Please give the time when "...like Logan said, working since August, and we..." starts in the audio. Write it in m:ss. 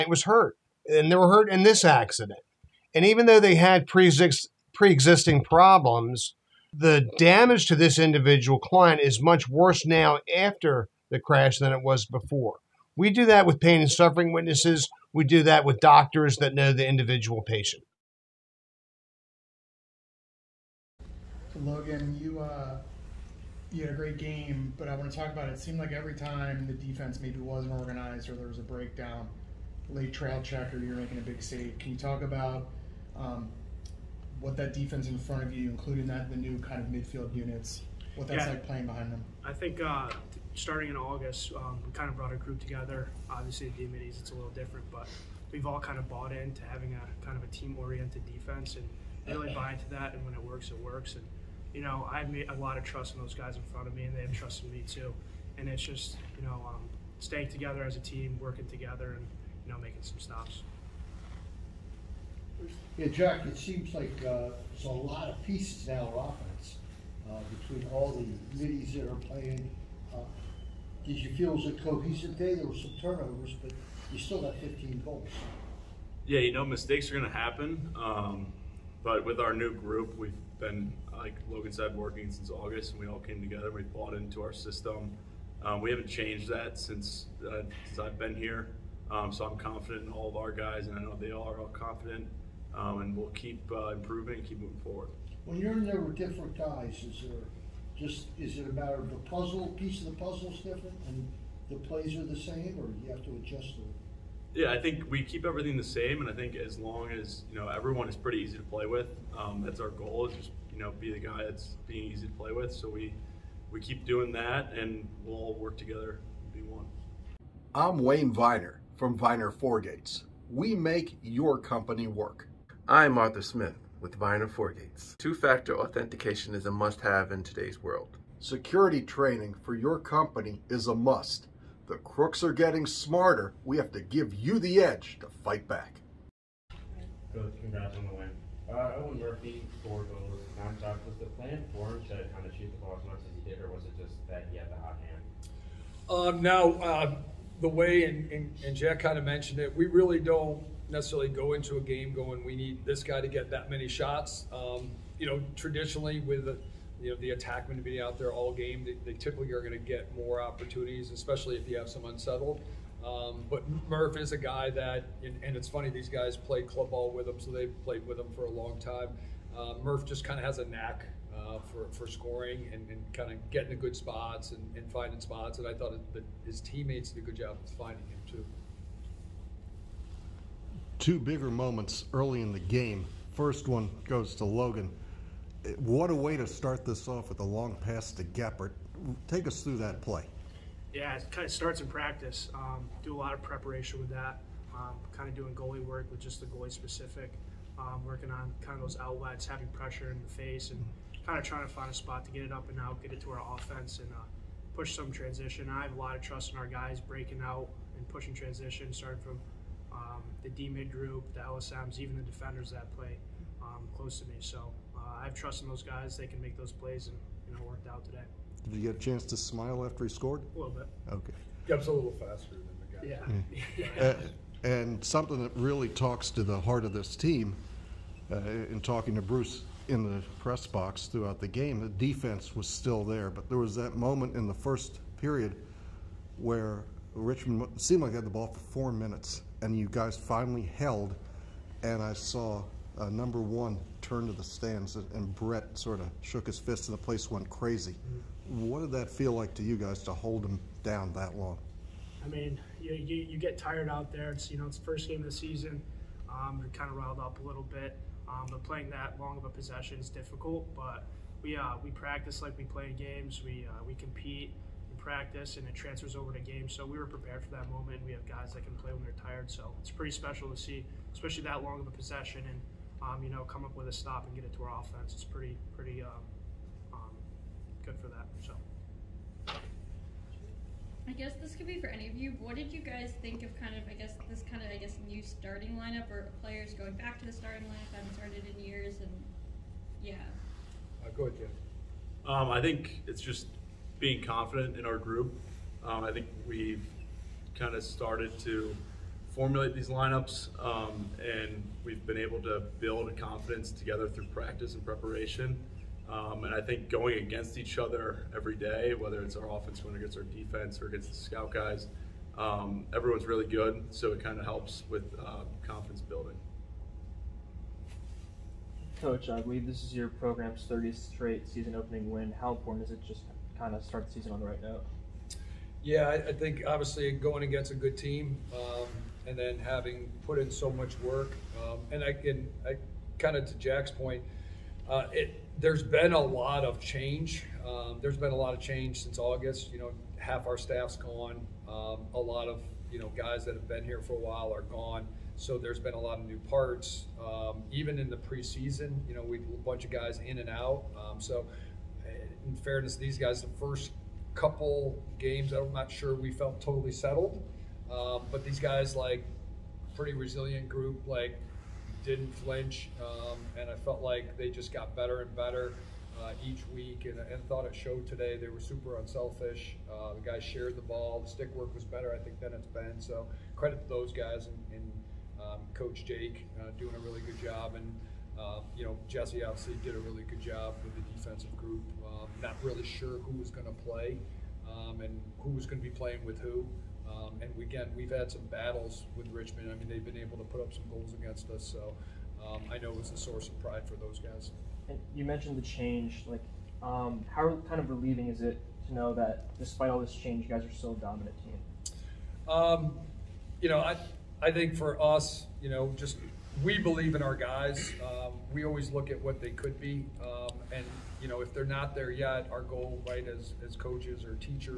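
1:21.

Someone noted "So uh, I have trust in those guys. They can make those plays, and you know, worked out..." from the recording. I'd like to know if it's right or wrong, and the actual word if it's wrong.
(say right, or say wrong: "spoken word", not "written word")
right.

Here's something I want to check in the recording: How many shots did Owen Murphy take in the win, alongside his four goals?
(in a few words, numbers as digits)
9.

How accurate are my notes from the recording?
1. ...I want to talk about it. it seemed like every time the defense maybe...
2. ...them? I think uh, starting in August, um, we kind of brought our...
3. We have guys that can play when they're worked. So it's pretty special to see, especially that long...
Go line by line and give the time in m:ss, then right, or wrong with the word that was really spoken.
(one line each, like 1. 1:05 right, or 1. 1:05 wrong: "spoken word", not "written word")
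1. 0:24 right
2. 0:39 right
3. 4:28 wrong: "tired", not "worked".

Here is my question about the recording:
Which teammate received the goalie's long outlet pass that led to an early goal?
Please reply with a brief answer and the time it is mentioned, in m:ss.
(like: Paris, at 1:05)
Geppert, at 3:08.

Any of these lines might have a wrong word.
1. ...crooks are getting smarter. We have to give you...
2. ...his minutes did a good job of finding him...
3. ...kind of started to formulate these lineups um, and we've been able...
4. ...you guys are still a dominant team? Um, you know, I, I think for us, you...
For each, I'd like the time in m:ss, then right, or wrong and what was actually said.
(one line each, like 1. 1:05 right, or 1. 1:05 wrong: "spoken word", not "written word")
1. 2:11 right
2. 2:56 wrong: "teammates", not "minutes"
3. 4:57 right
4. 6:40 right.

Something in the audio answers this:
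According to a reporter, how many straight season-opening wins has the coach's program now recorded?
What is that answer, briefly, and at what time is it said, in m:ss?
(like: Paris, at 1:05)
30, at 5:20.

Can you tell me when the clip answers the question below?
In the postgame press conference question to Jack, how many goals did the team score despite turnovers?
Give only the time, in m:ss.
1:14.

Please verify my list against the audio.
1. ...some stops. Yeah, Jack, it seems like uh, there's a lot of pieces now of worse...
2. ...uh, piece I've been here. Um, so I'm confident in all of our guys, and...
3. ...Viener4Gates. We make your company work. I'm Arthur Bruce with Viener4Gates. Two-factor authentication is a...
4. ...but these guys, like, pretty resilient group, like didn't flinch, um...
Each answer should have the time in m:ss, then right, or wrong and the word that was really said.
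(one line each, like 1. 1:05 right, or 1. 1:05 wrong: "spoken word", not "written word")
1. 1:00 wrong: "offense", not "worse"
2. 1:27 wrong: "since", not "piece"
3. 1:59 wrong: "Smith", not "Bruce"
4. 5:58 right.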